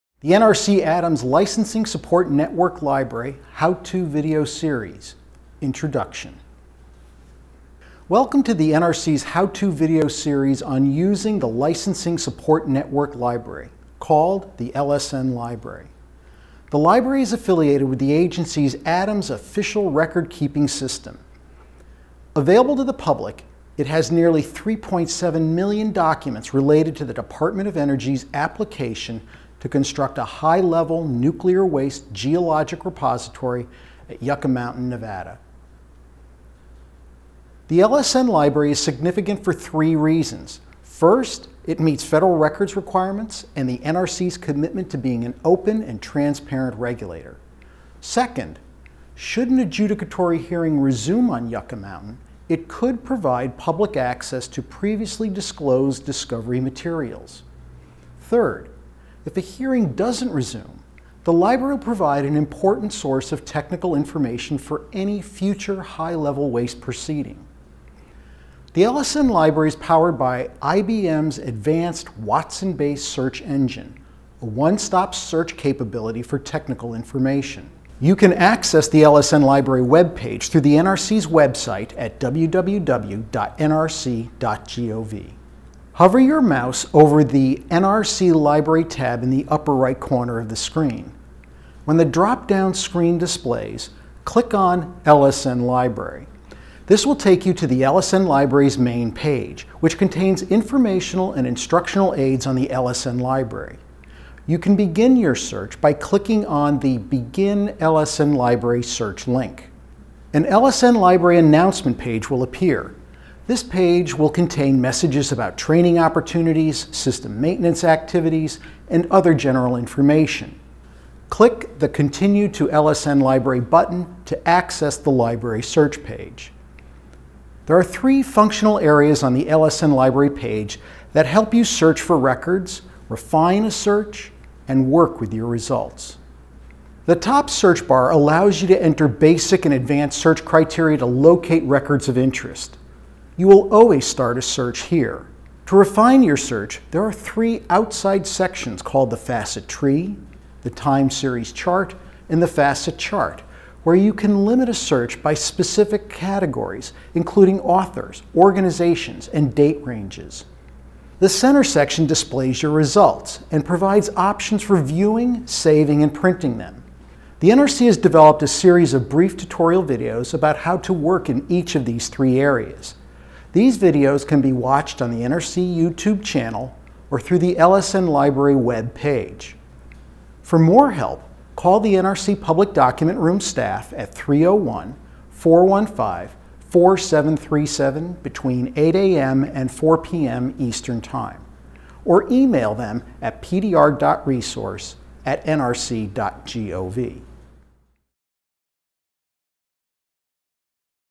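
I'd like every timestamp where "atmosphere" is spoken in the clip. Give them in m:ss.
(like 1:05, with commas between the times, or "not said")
not said.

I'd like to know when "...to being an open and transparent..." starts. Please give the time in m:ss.
0:44.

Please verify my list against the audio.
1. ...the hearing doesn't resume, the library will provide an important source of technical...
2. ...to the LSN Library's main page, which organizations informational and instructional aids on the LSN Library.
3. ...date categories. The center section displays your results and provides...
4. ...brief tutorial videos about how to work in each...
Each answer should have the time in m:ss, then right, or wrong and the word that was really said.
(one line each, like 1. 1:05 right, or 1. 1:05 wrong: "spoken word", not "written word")
1. 0:59 right
2. 1:37 wrong: "contains", not "organizations"
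3. 2:39 wrong: "ranges", not "categories"
4. 2:49 right.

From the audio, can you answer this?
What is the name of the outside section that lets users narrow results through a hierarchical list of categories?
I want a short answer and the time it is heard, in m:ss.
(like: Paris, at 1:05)
facet tree, at 2:29.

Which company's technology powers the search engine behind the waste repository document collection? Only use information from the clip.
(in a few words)
IBM.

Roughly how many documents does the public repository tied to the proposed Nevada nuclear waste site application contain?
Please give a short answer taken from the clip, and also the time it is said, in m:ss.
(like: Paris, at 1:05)
3.7 million, at 0:24.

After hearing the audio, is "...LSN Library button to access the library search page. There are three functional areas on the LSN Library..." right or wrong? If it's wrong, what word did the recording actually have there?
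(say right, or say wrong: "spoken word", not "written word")
right.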